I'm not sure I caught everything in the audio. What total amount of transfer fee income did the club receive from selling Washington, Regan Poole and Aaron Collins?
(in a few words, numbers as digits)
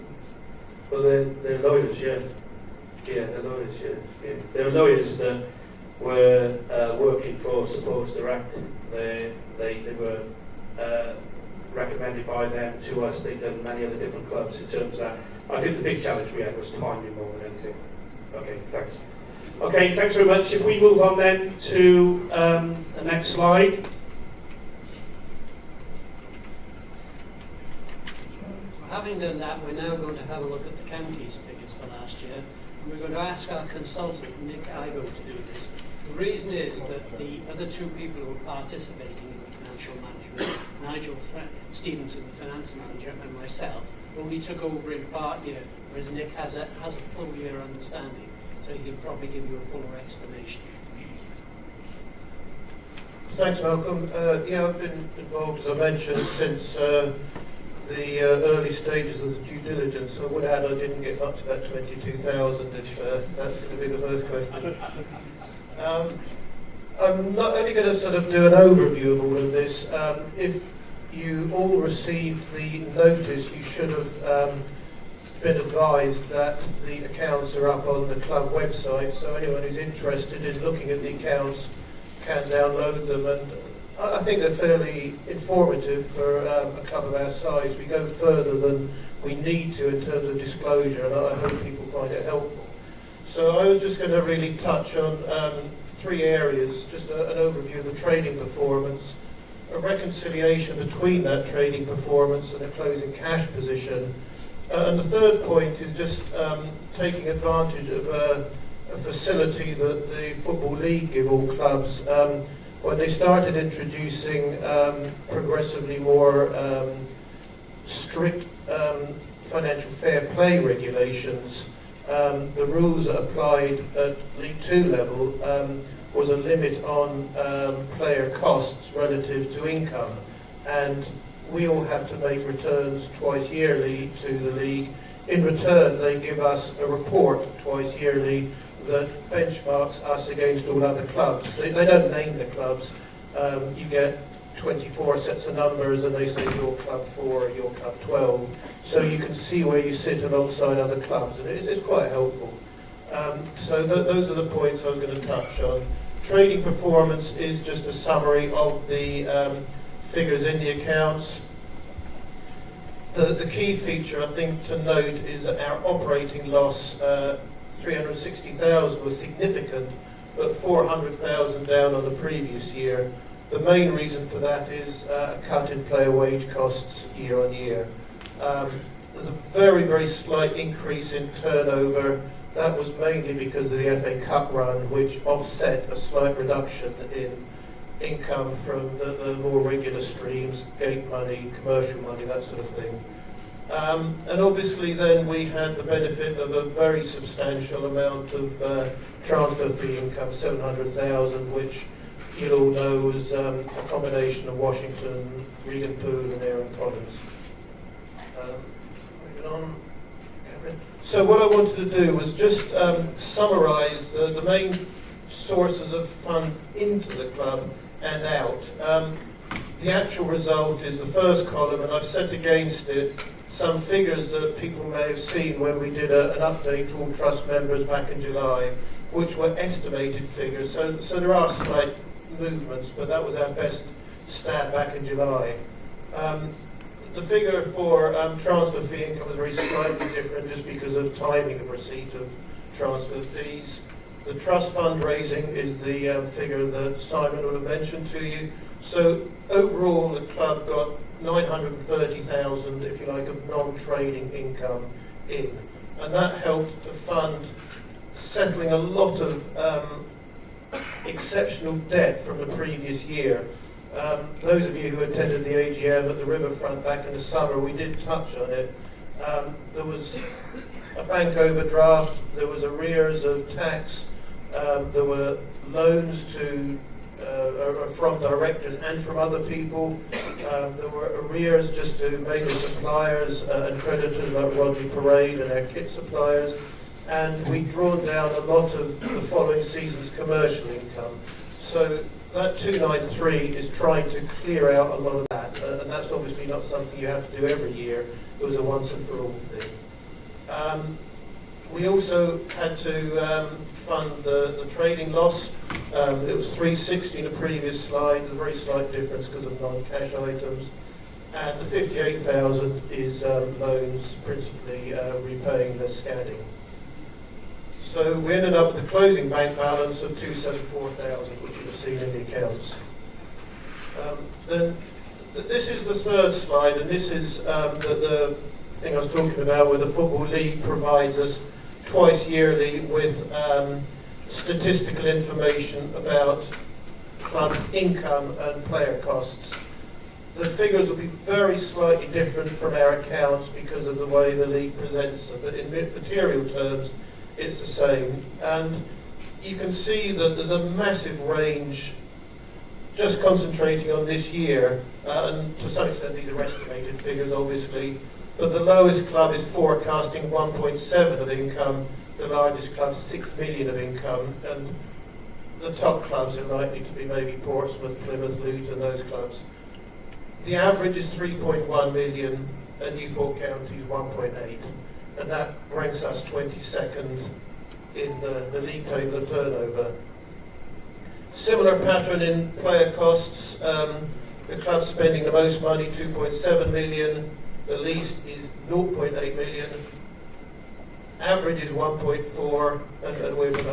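700,000.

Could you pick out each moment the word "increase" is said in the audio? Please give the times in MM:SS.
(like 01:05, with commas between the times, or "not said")
03:00.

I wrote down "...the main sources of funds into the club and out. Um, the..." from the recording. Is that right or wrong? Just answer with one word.
right.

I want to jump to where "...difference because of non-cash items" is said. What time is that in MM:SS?
05:08.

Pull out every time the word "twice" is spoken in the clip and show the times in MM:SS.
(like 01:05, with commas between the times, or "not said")
02:13, 02:17, 05:31.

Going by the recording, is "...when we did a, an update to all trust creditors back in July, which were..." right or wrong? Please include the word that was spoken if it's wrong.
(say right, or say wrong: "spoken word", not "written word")
wrong: "members", not "creditors".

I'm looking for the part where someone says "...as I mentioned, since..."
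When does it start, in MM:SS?
00:55.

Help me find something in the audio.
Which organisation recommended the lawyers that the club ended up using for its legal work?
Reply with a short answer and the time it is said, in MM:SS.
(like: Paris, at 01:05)
Support Direct, at 00:07.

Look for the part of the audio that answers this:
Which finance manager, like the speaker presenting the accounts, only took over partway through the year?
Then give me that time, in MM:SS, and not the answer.
00:40.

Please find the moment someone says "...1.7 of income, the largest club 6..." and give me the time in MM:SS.
06:00.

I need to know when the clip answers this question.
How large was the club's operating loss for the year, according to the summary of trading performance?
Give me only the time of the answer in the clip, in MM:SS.
02:47.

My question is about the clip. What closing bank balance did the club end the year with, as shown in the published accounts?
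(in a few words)
274,000.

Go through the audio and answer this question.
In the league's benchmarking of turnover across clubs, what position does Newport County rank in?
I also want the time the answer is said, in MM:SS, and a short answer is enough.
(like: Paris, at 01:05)
22nd, at 06:16.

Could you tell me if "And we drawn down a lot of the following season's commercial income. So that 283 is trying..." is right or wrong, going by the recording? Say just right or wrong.
wrong.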